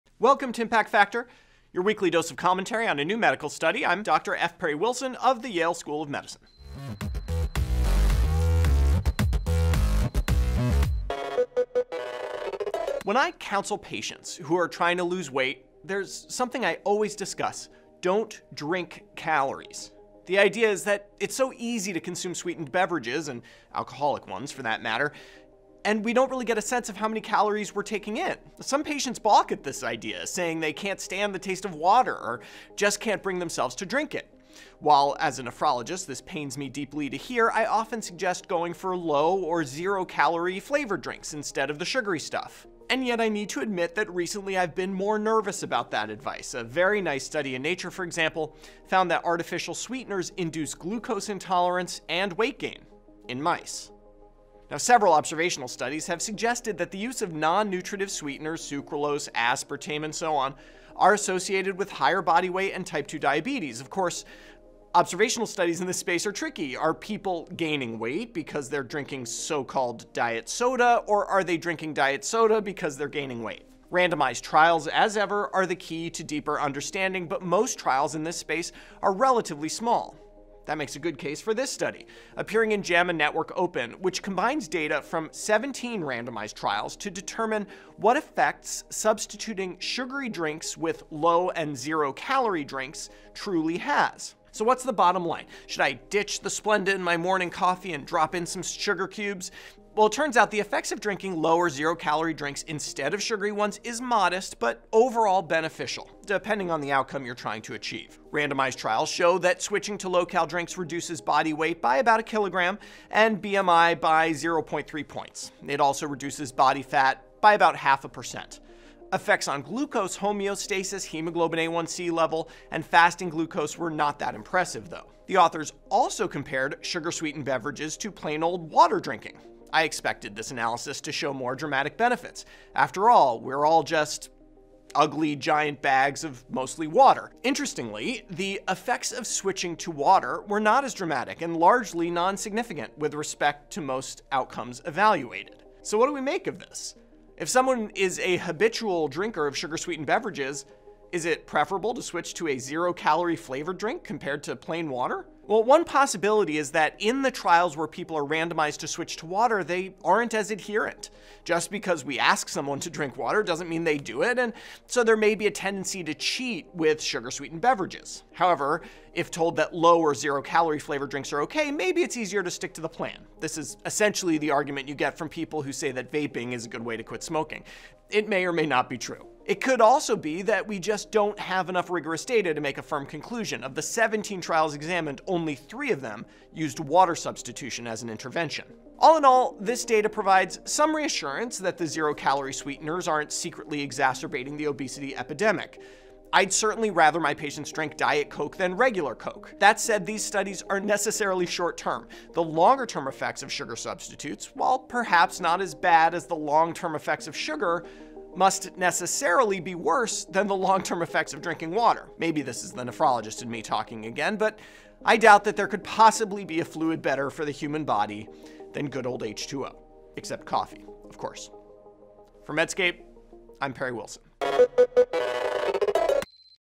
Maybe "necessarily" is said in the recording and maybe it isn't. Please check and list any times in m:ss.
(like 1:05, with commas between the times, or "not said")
3:20, 3:28.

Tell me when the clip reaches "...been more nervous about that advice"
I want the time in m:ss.
0:44.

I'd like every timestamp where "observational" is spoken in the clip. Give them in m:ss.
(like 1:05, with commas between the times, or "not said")
0:55, 1:04.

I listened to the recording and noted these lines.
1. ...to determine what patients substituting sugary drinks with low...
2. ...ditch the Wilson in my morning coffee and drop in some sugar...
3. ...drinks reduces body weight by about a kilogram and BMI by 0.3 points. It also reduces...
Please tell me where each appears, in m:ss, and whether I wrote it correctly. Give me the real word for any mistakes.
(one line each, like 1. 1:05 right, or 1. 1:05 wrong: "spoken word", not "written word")
1. 1:26 wrong: "effects", not "patients"
2. 1:35 wrong: "Splenda", not "Wilson"
3. 1:50 right.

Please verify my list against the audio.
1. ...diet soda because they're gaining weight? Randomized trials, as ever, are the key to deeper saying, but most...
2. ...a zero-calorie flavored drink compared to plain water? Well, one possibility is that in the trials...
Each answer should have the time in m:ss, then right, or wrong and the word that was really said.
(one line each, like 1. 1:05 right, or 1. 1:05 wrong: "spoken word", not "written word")
1. 1:11 wrong: "understanding", not "saying"
2. 2:32 right.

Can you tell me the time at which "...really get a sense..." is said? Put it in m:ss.
0:26.